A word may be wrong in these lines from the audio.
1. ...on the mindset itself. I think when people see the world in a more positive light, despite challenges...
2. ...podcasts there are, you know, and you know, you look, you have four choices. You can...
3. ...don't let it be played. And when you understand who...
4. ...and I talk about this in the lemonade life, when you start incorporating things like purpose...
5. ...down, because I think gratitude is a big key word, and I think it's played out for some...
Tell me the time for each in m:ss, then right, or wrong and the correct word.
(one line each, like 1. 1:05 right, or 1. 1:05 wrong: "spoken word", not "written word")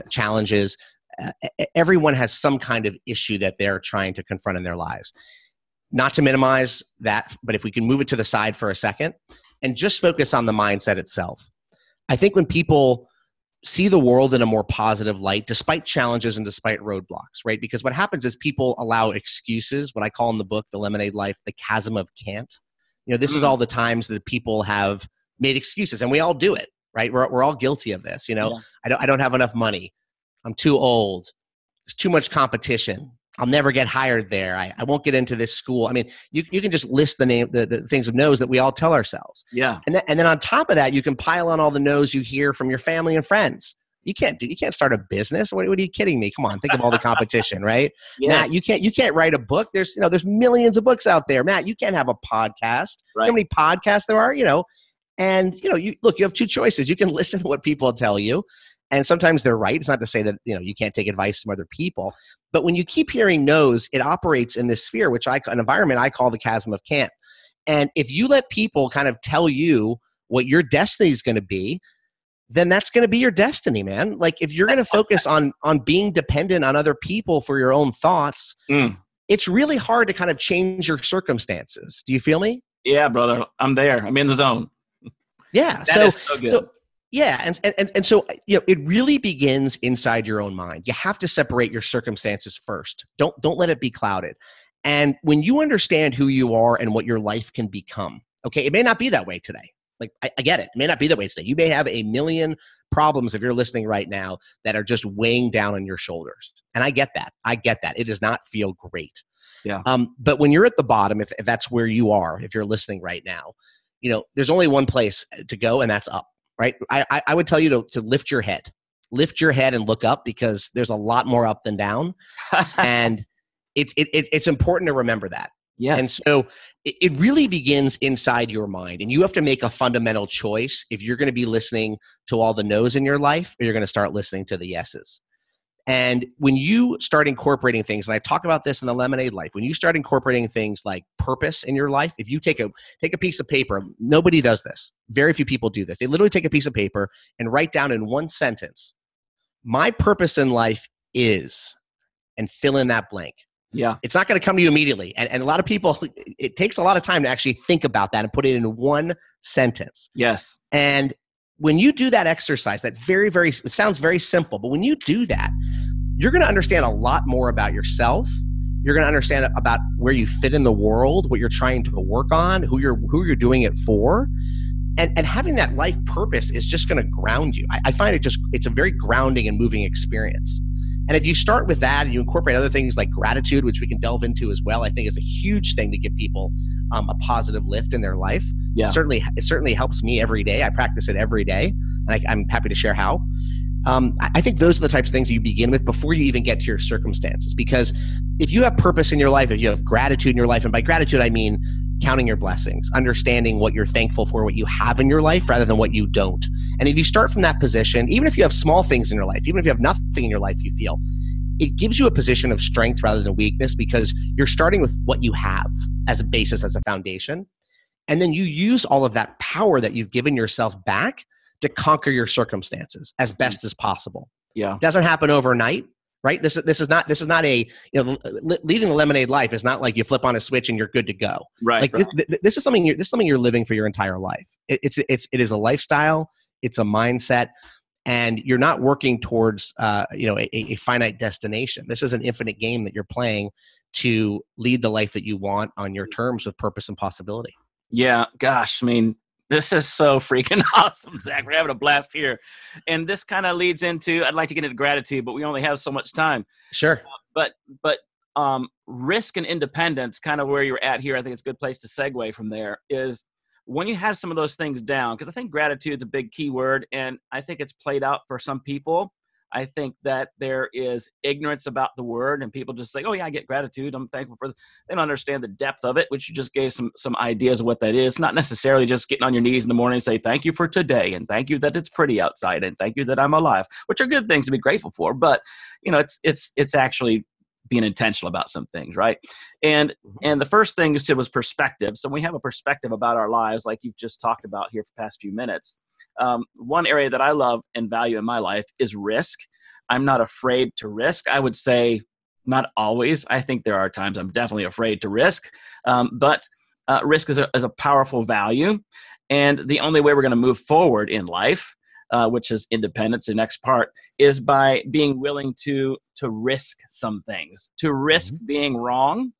1. 0:10 right
2. 0:53 wrong: "two", not "four"
3. 1:33 wrong: "clouded", not "played"
4. 2:18 right
5. 4:24 right.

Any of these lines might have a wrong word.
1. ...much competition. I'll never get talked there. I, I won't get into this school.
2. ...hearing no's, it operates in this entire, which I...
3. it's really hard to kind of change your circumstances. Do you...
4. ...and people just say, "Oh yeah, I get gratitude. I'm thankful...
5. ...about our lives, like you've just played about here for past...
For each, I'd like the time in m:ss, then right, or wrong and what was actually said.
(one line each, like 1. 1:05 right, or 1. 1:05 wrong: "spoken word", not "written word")
1. 0:32 wrong: "hired", not "talked"
2. 1:03 wrong: "sphere", not "entire"
3. 1:19 right
4. 4:32 right
5. 4:52 wrong: "talked", not "played".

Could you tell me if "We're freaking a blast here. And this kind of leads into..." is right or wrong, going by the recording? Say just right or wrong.
wrong.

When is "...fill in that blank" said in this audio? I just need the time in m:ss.
2:32.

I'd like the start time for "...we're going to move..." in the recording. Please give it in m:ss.
5:10.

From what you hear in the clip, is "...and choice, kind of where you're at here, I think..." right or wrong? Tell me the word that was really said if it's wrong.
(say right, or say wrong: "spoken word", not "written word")
wrong: "independence", not "choice".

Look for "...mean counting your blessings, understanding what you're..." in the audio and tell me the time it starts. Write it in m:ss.
3:21.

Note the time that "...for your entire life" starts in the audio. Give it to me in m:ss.
3:53.